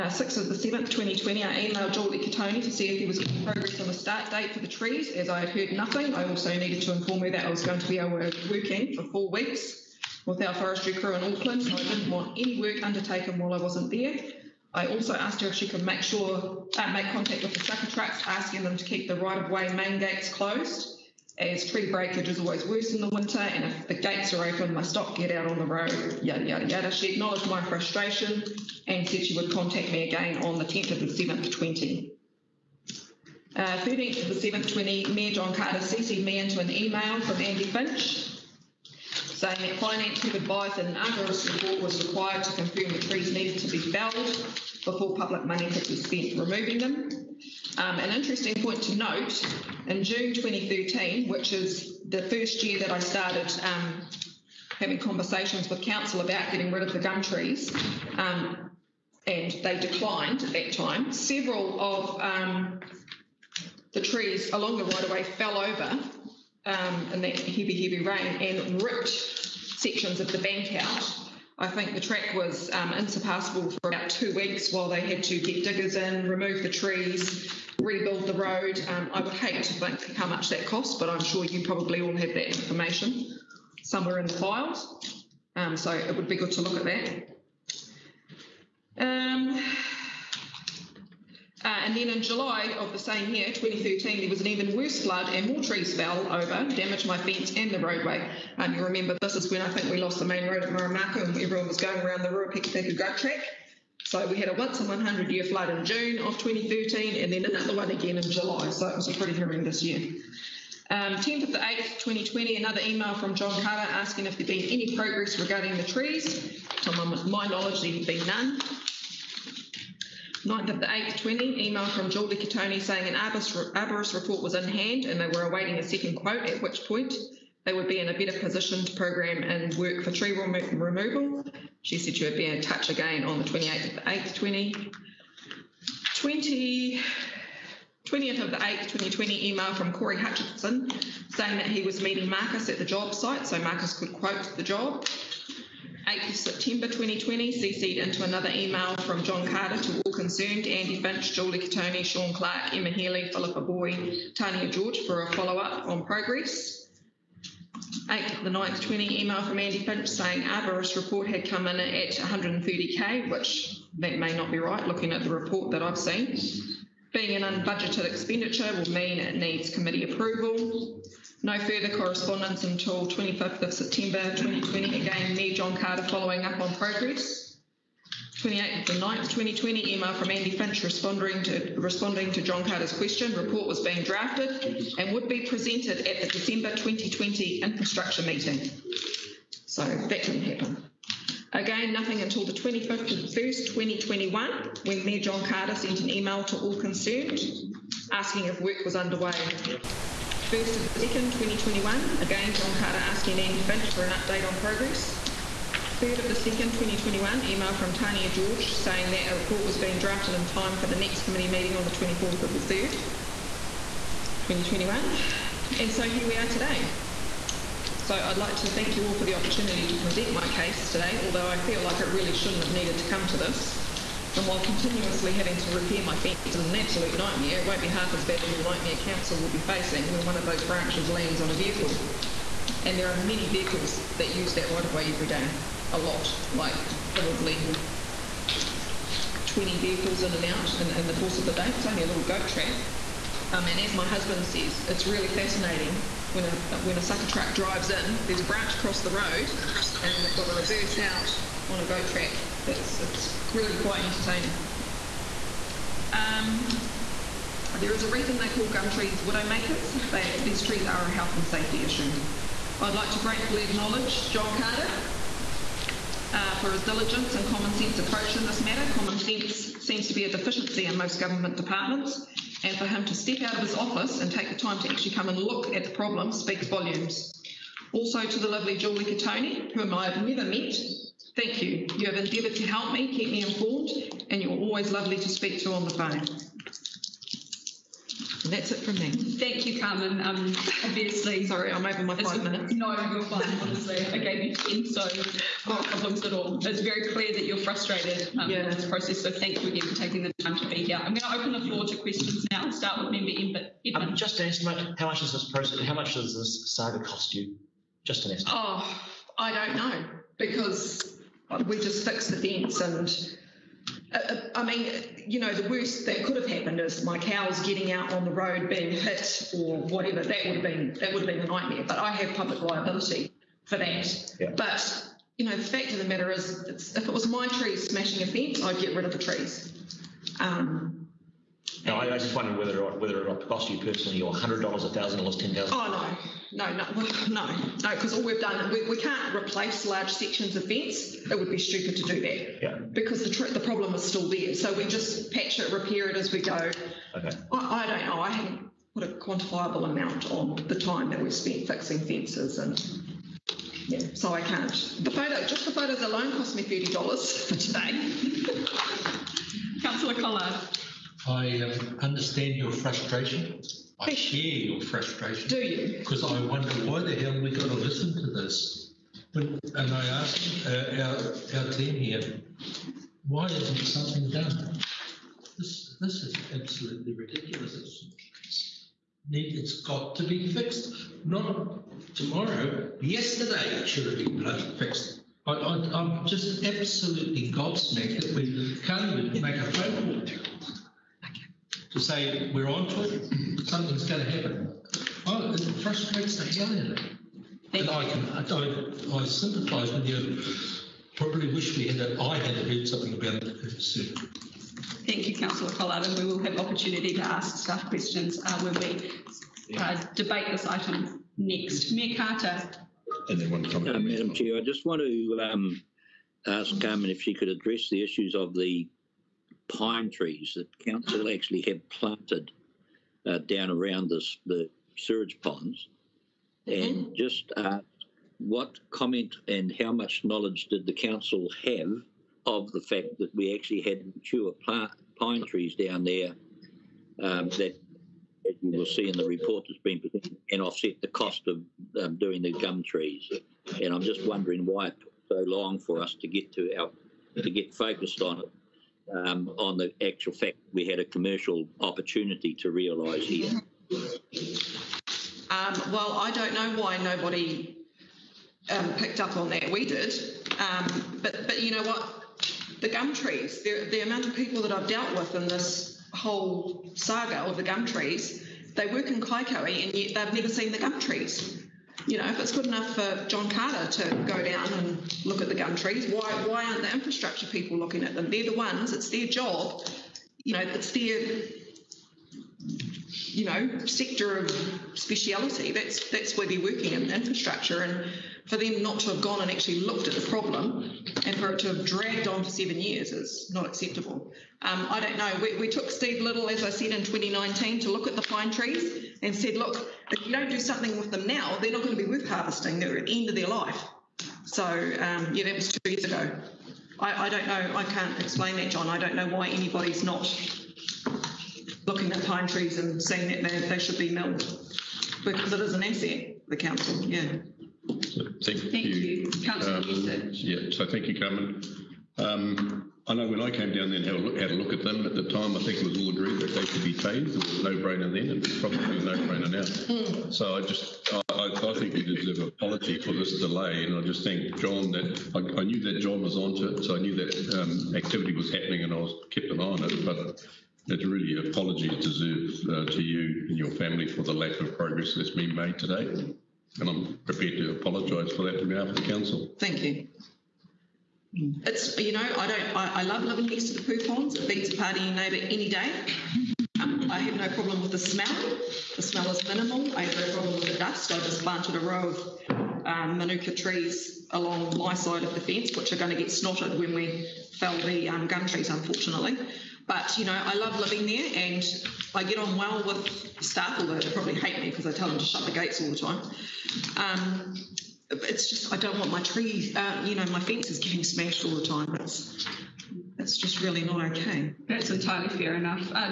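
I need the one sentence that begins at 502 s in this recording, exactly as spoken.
They're at the end of their life.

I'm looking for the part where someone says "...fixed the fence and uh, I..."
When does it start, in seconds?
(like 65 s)
312 s.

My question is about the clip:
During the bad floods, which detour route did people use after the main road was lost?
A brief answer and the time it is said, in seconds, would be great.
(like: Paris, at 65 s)
Ruapekapeka Grub Track, at 102 s.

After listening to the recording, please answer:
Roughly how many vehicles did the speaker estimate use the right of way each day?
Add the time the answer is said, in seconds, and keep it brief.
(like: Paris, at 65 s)
20, at 239 s.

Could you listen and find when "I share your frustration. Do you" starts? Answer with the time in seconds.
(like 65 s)
363 s.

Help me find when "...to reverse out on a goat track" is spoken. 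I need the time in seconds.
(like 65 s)
250 s.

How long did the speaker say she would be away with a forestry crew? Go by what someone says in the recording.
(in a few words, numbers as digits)
four weeks.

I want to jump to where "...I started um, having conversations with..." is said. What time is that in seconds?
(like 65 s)
52 s.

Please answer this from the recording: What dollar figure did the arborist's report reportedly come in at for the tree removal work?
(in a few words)
130k.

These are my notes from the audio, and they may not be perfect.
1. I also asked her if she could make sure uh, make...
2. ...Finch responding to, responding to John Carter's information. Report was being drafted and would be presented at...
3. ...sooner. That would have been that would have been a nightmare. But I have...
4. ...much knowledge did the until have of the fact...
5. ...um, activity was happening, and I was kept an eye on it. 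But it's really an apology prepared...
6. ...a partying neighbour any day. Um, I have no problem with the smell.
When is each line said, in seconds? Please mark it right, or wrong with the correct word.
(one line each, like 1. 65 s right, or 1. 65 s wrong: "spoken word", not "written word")
1. 14 s right
2. 180 s wrong: "question", not "information"
3. 319 s wrong: "whatever", not "sooner"
4. 429 s wrong: "council", not "until"
5. 537 s wrong: "deserved", not "prepared"
6. 554 s right.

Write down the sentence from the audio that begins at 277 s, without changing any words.
Also to the lovely Julie Catoni, whom I have never met.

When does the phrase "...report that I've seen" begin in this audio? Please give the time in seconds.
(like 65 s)
165 s.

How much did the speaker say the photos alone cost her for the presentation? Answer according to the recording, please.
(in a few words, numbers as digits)
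$30.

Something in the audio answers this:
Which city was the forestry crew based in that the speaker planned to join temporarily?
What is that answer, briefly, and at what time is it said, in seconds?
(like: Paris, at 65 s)
Auckland, at 11 s.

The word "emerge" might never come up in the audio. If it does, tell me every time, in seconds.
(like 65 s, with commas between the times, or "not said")
not said.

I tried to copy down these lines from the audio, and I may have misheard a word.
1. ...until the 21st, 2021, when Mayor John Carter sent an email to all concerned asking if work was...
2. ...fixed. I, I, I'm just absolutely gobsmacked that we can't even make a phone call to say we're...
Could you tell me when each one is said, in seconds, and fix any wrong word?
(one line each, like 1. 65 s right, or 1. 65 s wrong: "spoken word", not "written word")
1. 192 s right
2. 384 s right.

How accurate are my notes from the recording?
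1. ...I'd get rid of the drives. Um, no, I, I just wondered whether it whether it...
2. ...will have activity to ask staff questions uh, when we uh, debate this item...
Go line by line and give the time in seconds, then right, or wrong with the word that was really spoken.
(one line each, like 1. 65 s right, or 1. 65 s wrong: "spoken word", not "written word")
1. 328 s wrong: "trees", not "drives"
2. 406 s wrong: "opportunity", not "activity".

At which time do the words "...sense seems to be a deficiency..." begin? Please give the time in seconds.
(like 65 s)
269 s.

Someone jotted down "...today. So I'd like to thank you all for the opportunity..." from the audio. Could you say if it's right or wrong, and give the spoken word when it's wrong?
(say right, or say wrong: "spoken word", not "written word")
right.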